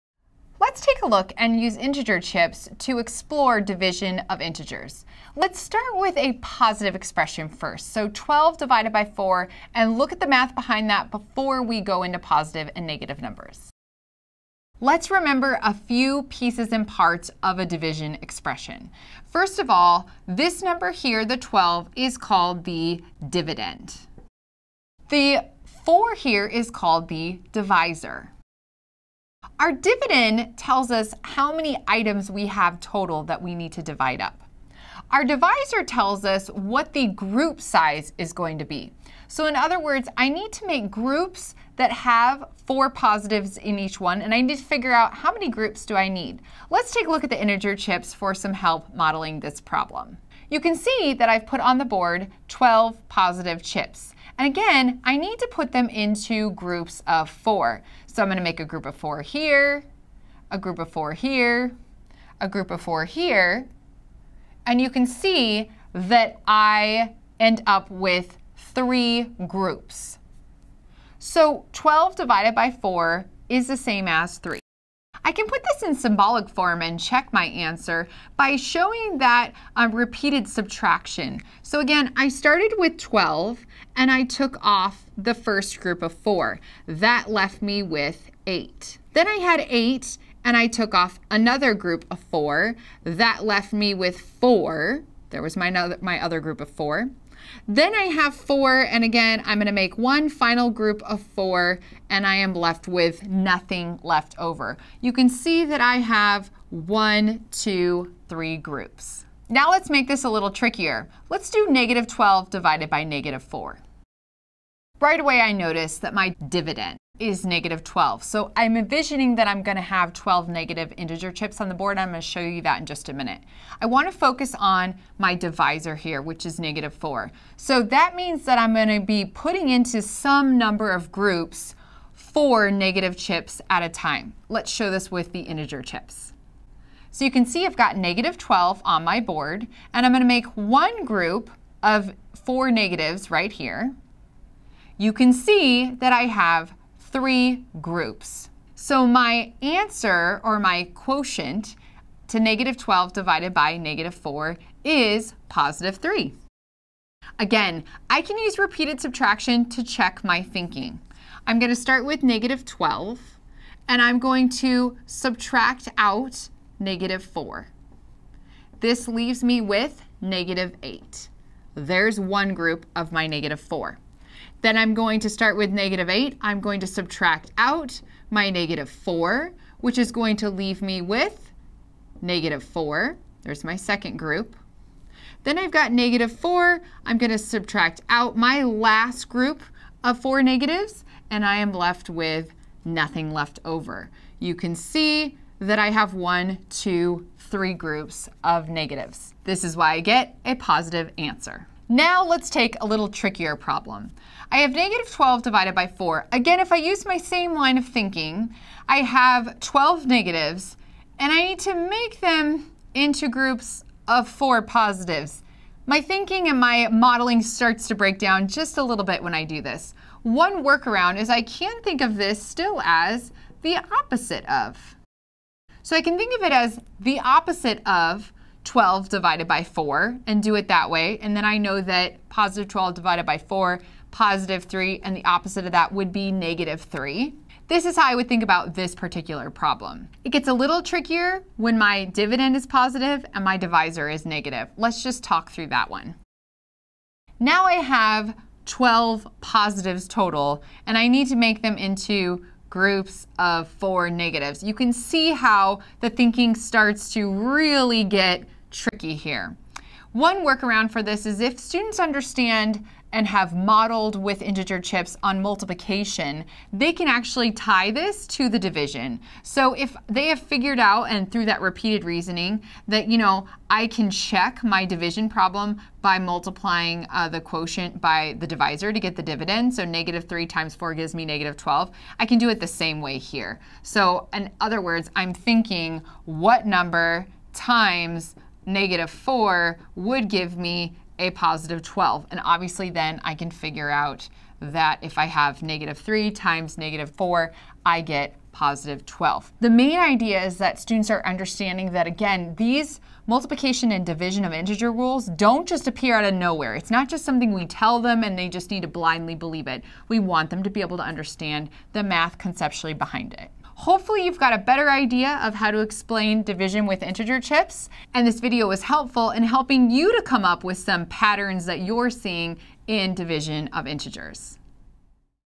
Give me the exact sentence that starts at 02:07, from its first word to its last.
So that means that I'm going to be putting into some number of groups four negative chips at a time.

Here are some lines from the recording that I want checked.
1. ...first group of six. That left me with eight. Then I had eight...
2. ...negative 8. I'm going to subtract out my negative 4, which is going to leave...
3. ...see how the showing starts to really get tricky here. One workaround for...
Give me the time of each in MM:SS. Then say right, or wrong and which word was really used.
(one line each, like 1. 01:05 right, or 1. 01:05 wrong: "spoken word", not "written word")
1. 01:25 wrong: "four", not "six"
2. 02:55 right
3. 04:14 wrong: "thinking", not "showing".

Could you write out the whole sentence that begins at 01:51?
Let's do negative 12 divided by negative four.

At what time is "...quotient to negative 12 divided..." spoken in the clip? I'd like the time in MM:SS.
02:30.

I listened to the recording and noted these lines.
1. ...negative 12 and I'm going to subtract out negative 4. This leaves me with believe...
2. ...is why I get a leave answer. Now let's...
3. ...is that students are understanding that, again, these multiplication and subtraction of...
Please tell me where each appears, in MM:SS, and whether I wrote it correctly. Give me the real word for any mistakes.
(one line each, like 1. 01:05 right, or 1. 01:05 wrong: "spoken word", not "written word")
1. 02:42 wrong: "negative", not "believe"
2. 03:19 wrong: "positive", not "leave"
3. 05:00 wrong: "division", not "subtraction".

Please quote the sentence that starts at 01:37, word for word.
Then I have four, and again, I'm gonna make one final group of four, and I am left with nothing left over.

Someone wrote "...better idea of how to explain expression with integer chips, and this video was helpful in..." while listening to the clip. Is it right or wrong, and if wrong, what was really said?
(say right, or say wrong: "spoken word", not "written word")
wrong: "division", not "expression".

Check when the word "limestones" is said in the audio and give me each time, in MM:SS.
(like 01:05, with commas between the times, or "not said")
not said.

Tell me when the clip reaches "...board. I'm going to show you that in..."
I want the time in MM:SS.
02:01.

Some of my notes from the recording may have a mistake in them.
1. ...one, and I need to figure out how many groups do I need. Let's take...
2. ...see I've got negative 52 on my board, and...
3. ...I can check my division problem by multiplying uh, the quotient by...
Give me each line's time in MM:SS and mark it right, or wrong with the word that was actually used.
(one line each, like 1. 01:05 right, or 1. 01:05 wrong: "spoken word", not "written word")
1. 00:44 right
2. 02:17 wrong: "12", not "52"
3. 04:33 right.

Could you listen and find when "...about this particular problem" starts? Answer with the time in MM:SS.
03:58.